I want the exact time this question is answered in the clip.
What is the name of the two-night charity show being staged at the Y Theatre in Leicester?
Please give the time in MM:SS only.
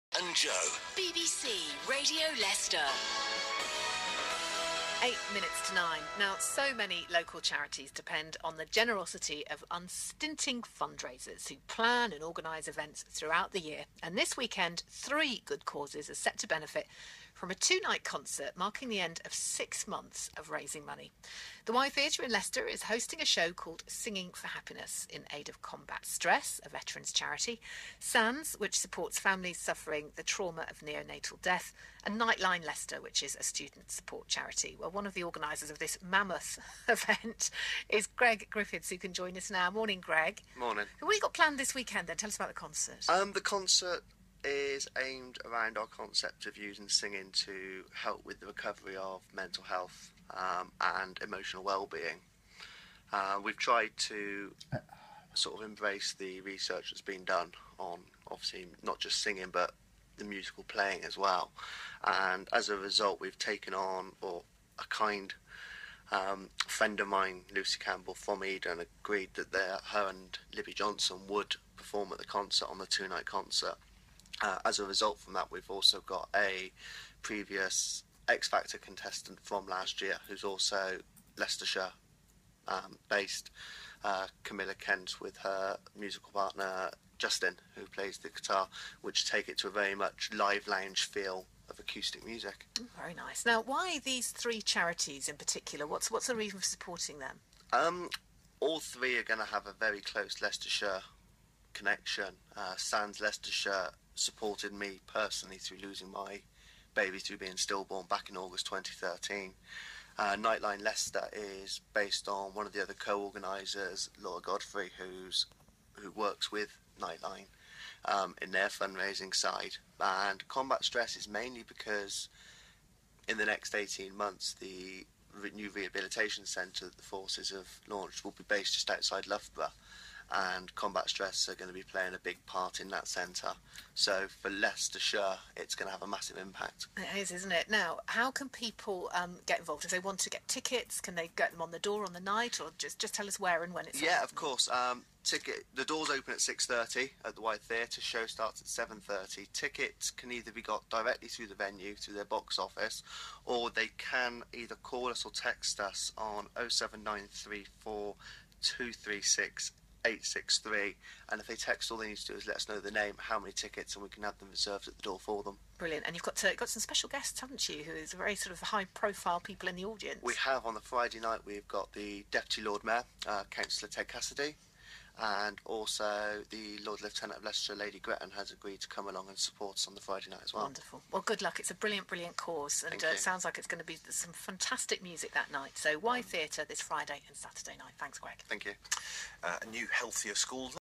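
00:23.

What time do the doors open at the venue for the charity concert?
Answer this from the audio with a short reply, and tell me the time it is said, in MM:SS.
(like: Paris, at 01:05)
6:30, at 02:26.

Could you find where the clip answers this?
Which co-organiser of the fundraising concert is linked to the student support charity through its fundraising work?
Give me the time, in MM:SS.
01:54.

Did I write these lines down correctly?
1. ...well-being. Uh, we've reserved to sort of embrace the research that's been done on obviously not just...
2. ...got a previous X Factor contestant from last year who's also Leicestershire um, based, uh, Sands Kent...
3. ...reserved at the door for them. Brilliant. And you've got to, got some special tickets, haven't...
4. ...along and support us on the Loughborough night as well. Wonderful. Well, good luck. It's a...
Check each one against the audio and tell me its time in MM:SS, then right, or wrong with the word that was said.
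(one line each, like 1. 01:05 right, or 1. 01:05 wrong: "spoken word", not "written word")
1. 00:51 wrong: "tried", not "reserved"
2. 01:16 wrong: "Camilla", not "Sands"
3. 02:44 wrong: "guests", not "tickets"
4. 02:59 wrong: "Friday", not "Loughborough".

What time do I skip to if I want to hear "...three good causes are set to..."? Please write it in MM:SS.
00:14.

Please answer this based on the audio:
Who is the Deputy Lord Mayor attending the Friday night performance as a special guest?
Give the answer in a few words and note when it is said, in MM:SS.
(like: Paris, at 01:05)
Councillor Ted Cassidy, at 02:53.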